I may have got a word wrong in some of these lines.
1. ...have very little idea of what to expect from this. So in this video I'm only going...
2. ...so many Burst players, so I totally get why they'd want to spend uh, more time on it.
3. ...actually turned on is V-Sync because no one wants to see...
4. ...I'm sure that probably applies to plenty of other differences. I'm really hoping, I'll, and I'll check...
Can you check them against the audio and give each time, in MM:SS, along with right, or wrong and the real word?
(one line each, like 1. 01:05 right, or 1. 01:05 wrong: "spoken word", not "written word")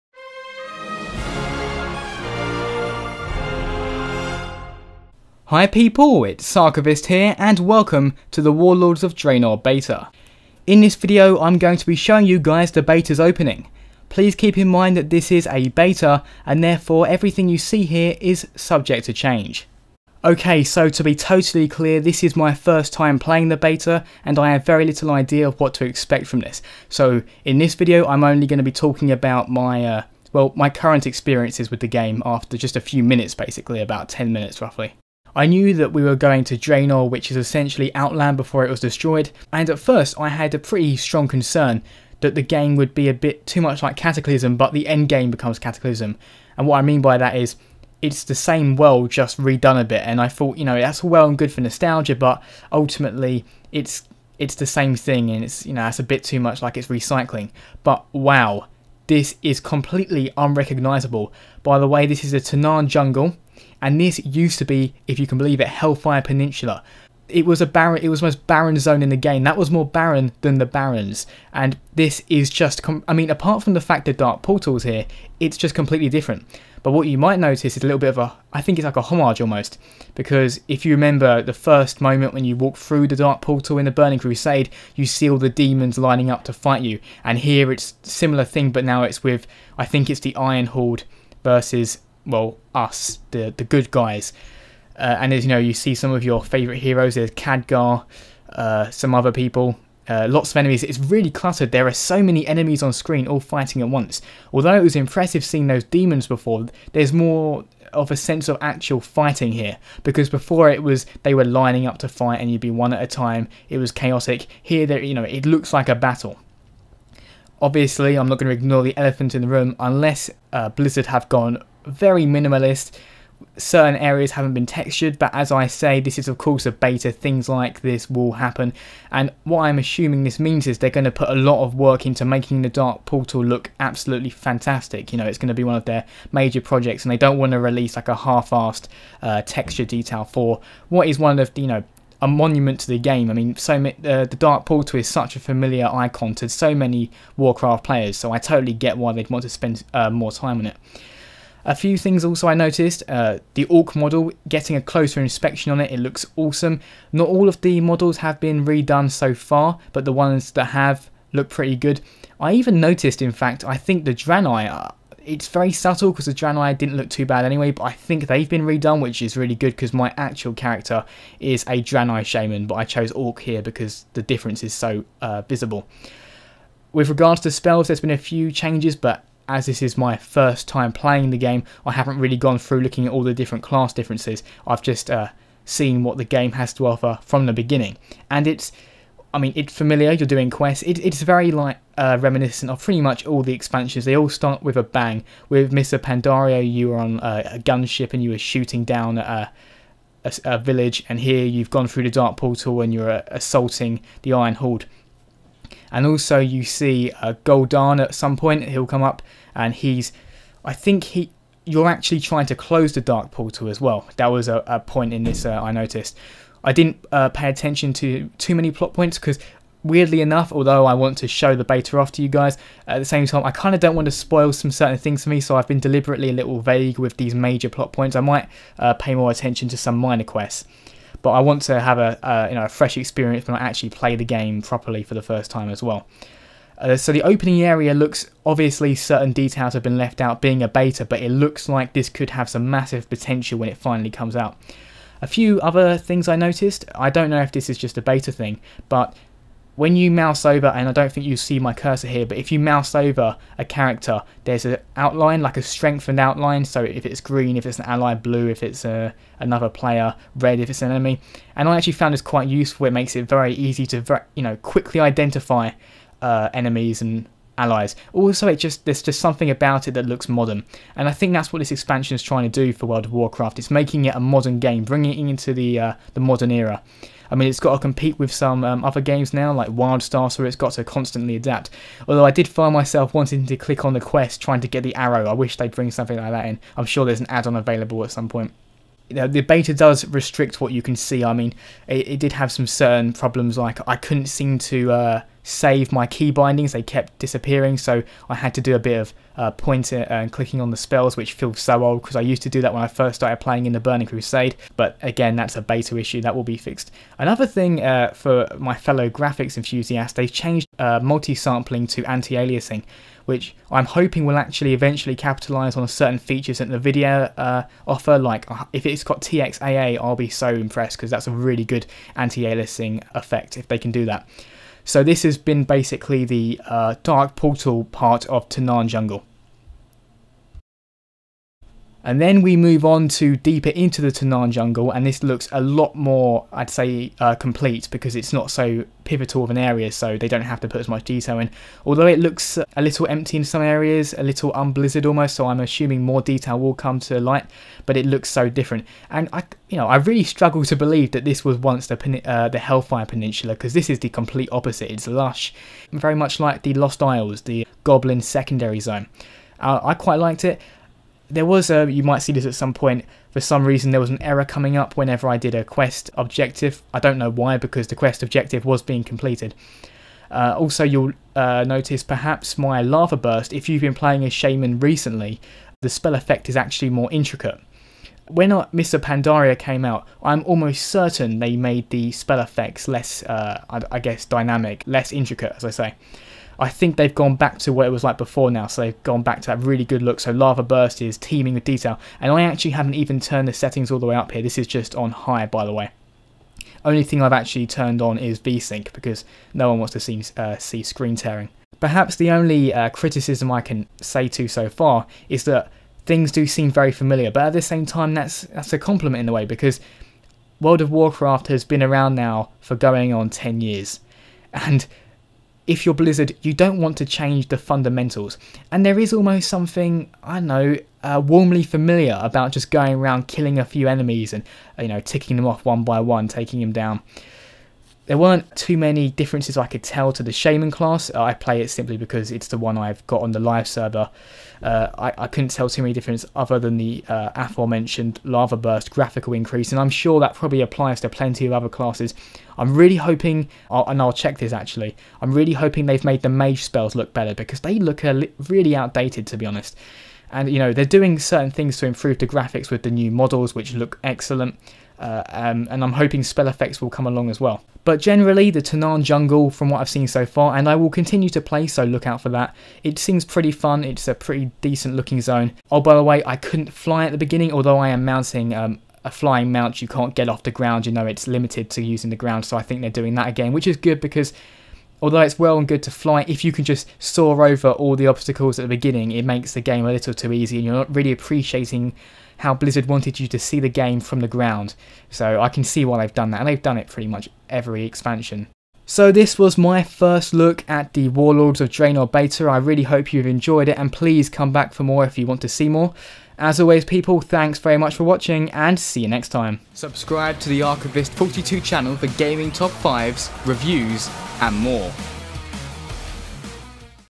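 1. 00:24 right
2. 02:26 wrong: "Warcraft", not "Burst"
3. 06:37 right
4. 07:19 wrong: "classes", not "differences".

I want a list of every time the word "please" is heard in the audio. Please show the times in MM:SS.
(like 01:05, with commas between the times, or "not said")
00:14, 08:13.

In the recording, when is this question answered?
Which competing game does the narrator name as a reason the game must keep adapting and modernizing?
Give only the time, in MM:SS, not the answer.
04:39.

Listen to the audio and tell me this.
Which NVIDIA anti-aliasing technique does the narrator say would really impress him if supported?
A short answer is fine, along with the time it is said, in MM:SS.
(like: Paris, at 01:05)
TXAA, at 05:19.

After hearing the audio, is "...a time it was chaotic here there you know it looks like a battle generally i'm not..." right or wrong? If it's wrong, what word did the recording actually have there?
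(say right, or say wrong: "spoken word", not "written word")
wrong: "obviously", not "generally".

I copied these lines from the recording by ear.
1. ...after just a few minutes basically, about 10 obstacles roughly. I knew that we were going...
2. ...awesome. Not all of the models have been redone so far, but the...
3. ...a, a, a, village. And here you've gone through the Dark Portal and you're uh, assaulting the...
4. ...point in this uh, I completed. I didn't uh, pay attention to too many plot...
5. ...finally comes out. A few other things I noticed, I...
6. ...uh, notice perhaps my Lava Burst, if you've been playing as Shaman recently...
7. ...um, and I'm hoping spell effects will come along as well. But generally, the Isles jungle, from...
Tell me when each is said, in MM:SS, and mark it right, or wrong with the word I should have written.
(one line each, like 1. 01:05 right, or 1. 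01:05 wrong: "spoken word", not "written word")
1. 00:32 wrong: "minutes", not "obstacles"
2. 02:36 right
3. 03:19 right
4. 03:34 wrong: "noticed", not "completed"
5. 04:03 right
6. 06:11 right
7. 07:35 wrong: "Tanaan", not "Isles".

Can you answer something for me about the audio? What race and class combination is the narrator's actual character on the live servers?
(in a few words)
Draenei Shaman.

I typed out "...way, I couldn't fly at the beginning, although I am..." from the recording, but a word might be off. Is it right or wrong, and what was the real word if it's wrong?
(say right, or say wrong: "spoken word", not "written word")
right.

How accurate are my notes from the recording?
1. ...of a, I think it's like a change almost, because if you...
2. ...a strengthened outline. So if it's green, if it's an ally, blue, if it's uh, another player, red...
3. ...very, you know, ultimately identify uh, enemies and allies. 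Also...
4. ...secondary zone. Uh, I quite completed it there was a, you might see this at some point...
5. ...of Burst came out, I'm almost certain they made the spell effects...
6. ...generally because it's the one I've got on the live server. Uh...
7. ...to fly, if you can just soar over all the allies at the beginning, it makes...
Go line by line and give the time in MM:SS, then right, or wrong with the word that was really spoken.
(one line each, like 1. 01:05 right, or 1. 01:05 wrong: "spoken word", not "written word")
1. 01:18 wrong: "homage", not "change"
2. 04:15 right
3. 04:24 wrong: "quickly", not "ultimately"
4. 05:58 wrong: "liked", not "completed"
5. 06:18 wrong: "Pandaria", not "Burst"
6. 07:11 wrong: "simply", not "generally"
7. 07:55 wrong: "obstacles", not "allies".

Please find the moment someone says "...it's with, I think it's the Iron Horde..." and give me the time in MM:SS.
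01:29.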